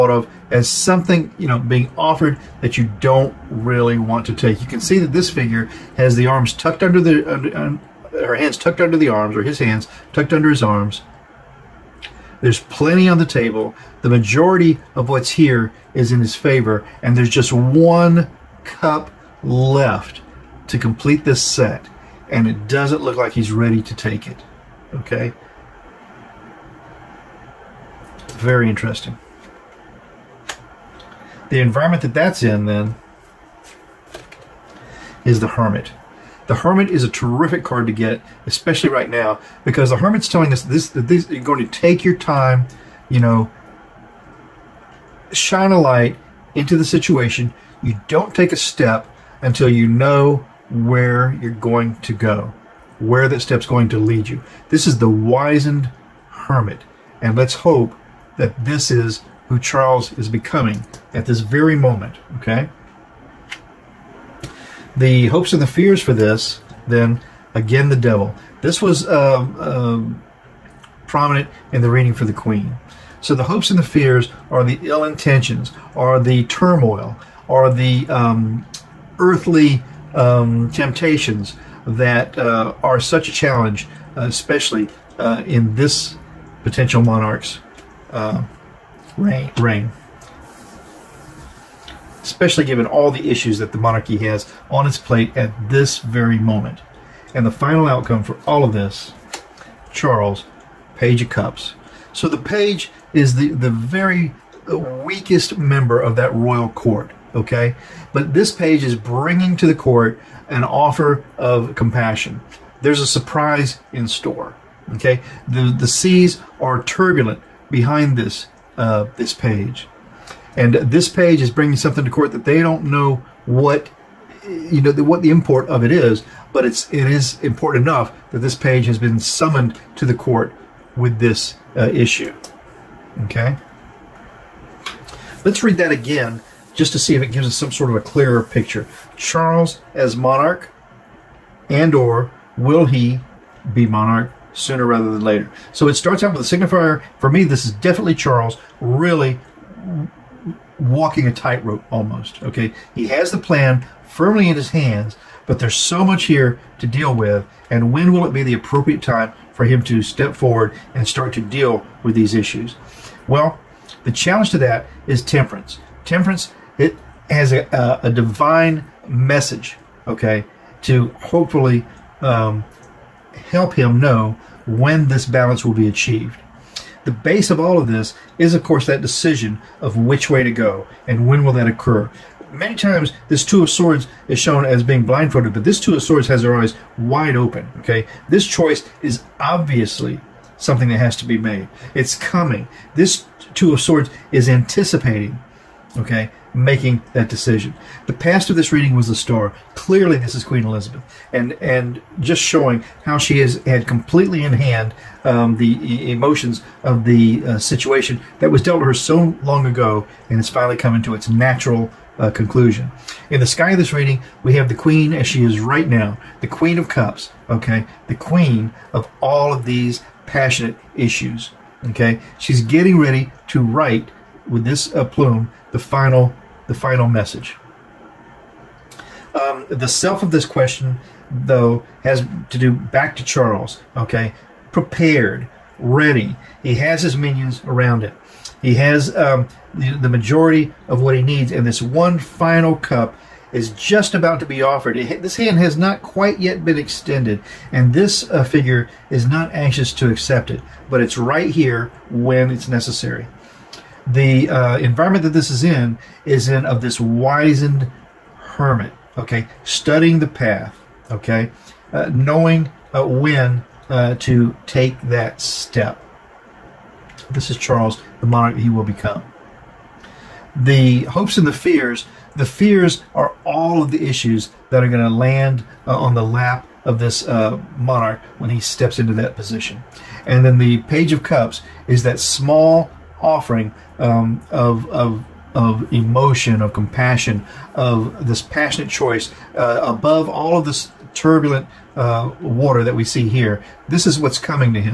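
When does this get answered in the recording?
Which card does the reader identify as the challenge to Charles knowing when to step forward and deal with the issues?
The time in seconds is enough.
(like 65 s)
164 s.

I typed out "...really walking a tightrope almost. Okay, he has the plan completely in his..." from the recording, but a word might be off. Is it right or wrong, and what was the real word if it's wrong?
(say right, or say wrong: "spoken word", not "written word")
wrong: "firmly", not "completely".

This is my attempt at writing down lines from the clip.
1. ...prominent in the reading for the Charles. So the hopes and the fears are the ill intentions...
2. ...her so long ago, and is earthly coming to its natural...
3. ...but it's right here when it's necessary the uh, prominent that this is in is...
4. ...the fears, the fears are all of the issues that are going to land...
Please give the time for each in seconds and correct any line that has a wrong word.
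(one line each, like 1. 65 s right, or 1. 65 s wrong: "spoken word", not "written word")
1. 71 s wrong: "Queen", not "Charles"
2. 208 s wrong: "finally", not "earthly"
3. 250 s wrong: "environment", not "prominent"
4. 271 s right.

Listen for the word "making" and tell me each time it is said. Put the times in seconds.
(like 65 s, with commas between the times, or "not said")
196 s.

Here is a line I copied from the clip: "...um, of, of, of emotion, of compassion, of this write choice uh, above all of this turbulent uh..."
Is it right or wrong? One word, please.
wrong.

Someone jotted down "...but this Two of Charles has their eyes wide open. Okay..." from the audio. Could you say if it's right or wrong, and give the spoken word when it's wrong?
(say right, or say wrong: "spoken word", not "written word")
wrong: "Swords", not "Charles".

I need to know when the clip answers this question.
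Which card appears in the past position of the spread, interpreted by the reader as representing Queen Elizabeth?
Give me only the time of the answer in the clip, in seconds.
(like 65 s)
198 s.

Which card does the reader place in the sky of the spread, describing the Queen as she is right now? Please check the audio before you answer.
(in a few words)
Queen of Cups.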